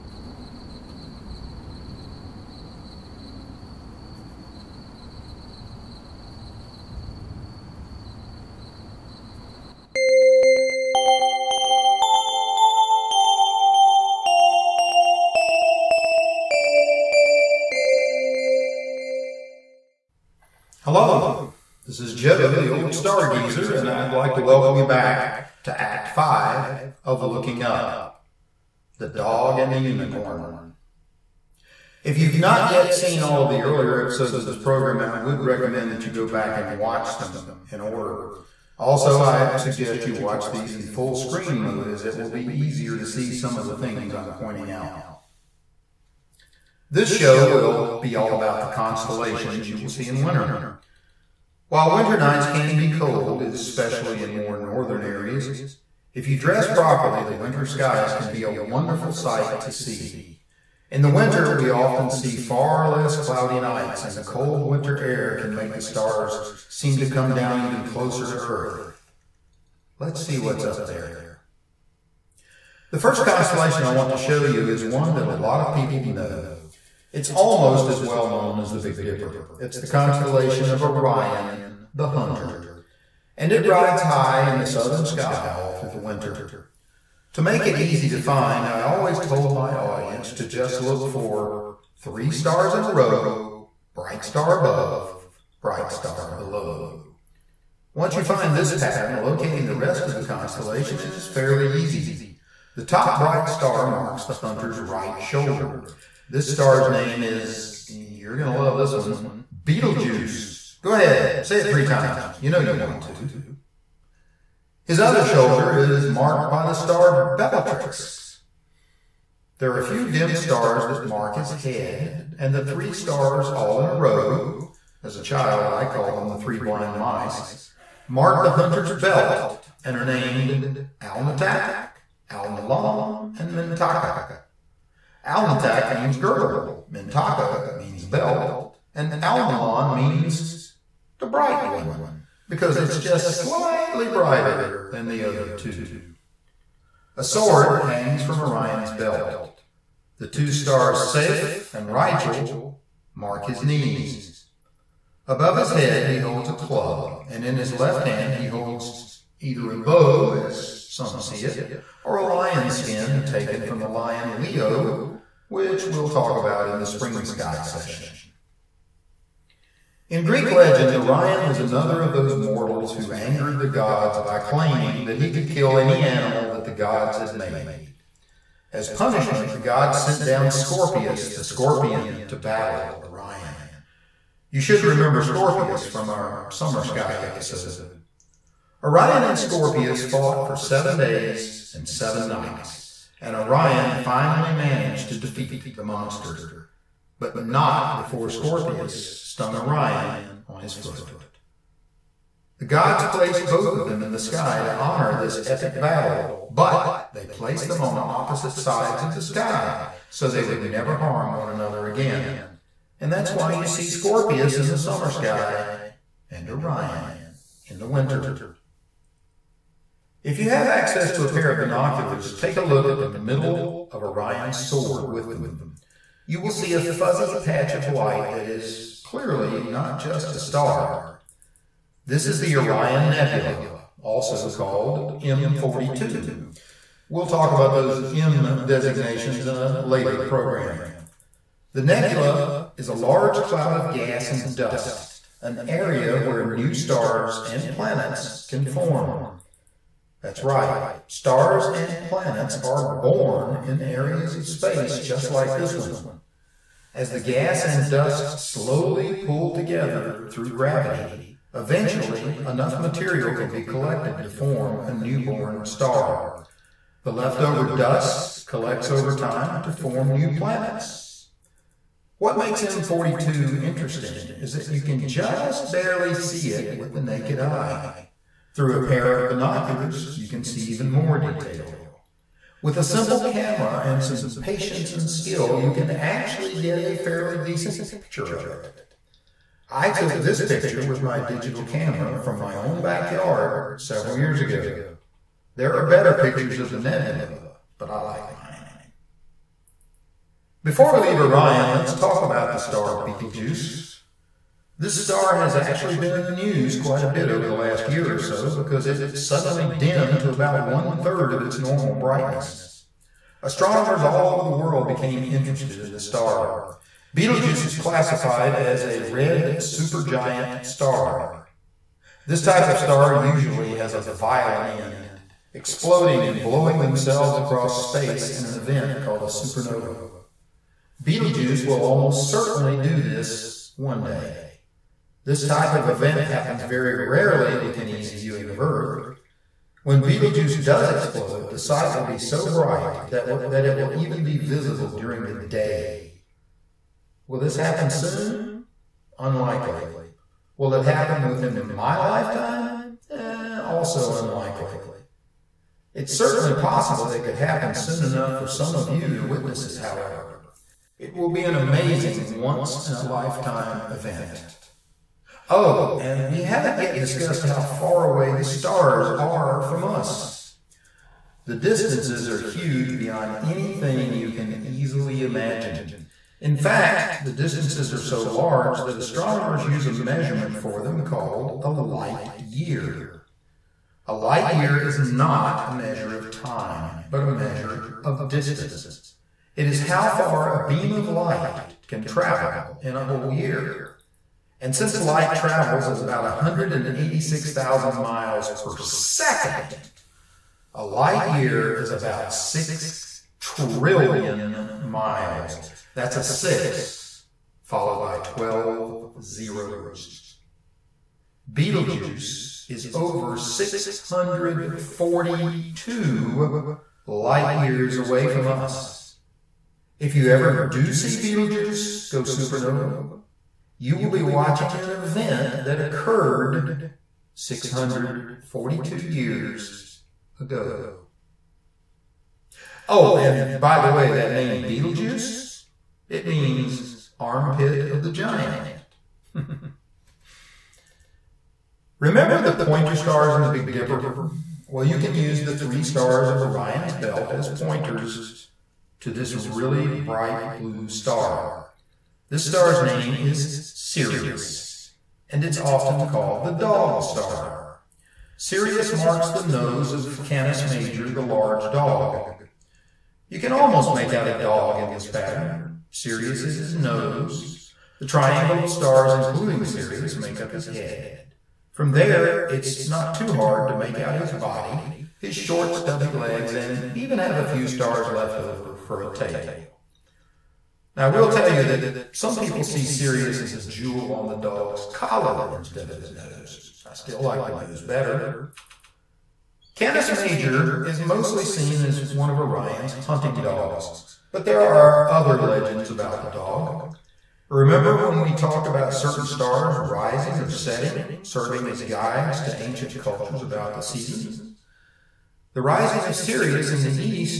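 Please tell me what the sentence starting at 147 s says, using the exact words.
A sword hangs from Orion's belt.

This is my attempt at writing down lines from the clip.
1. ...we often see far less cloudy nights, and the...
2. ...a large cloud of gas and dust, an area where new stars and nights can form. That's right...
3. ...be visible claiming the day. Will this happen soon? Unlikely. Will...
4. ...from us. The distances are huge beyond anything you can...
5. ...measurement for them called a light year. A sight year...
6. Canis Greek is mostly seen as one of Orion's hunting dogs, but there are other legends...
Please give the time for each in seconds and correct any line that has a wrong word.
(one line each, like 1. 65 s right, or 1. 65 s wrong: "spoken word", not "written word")
1. 61 s right
2. 242 s wrong: "planets", not "nights"
3. 344 s wrong: "during", not "claiming"
4. 369 s right
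5. 379 s wrong: "light", not "sight"
6. 489 s wrong: "Major", not "Greek".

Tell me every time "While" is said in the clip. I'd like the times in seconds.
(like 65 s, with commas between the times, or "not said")
51 s.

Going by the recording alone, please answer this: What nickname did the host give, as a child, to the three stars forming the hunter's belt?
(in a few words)
the three blind mice.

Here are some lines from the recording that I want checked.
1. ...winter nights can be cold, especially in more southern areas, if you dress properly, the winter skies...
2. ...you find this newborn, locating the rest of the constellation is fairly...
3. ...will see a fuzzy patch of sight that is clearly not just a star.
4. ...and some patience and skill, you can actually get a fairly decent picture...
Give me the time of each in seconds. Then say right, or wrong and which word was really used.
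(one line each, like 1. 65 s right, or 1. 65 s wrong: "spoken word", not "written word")
1. 51 s wrong: "northern", not "southern"
2. 98 s wrong: "pattern", not "newborn"
3. 226 s wrong: "light", not "sight"
4. 283 s right.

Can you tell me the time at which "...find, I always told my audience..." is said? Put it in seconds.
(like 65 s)
88 s.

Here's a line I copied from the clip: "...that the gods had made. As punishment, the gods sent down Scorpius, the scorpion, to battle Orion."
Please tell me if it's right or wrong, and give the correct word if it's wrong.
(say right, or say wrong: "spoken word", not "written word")
right.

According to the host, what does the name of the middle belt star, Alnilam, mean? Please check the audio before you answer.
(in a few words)
the bright one.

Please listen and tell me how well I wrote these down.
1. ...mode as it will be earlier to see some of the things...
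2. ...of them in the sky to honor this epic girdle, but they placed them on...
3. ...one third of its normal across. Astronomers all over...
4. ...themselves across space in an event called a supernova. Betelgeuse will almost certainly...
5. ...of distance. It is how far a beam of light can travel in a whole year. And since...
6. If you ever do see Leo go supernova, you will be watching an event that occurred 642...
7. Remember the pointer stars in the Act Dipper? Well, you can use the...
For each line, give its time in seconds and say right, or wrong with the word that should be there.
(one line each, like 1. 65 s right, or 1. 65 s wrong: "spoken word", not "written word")
1. 41 s wrong: "easier", not "earlier"
2. 203 s wrong: "battle", not "girdle"
3. 310 s wrong: "brightness", not "across"
4. 326 s right
5. 388 s right
6. 419 s wrong: "Betelgeuse", not "Leo"
7. 441 s wrong: "Big", not "Act".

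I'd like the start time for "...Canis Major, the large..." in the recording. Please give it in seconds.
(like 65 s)
460 s.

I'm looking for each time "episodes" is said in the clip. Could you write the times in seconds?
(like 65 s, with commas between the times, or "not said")
33 s, 187 s.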